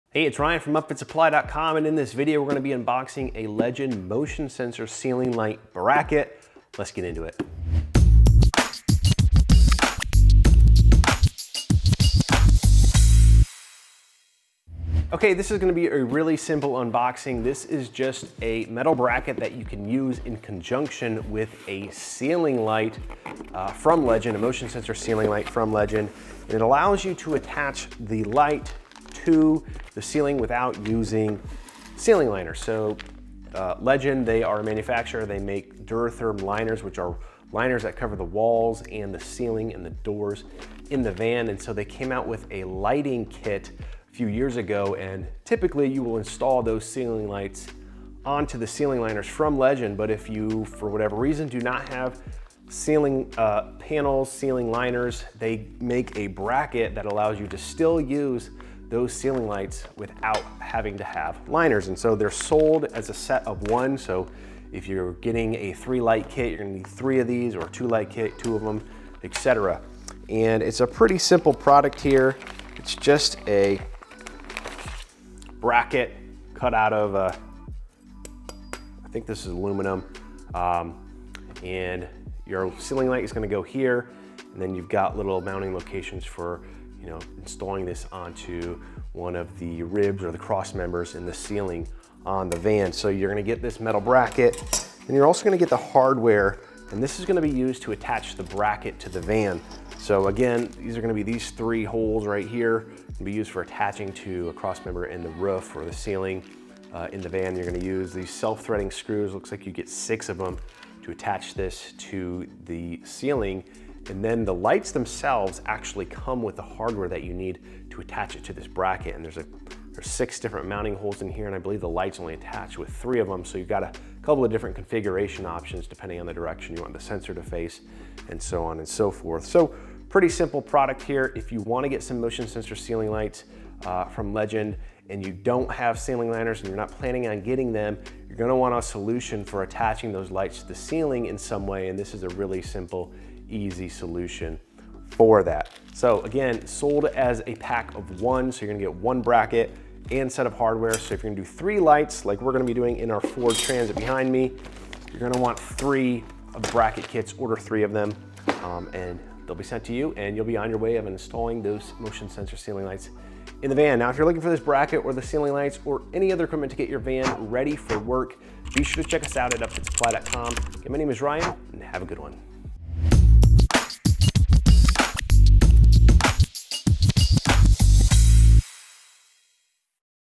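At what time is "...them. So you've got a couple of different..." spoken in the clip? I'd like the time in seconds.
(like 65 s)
123 s.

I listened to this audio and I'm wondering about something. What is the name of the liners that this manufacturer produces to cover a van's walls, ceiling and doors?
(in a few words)
Duratherm.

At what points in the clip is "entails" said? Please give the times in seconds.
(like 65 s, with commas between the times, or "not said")
not said.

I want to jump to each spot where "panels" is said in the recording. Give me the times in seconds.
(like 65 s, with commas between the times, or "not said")
53 s.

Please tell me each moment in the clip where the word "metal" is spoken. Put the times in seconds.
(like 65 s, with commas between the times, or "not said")
18 s, 93 s.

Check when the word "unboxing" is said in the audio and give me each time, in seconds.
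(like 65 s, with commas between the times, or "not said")
2 s, 16 s.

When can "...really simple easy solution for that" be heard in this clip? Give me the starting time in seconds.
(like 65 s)
142 s.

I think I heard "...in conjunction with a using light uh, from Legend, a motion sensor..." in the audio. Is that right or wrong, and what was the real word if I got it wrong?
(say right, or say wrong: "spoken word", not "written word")
wrong: "ceiling", not "using".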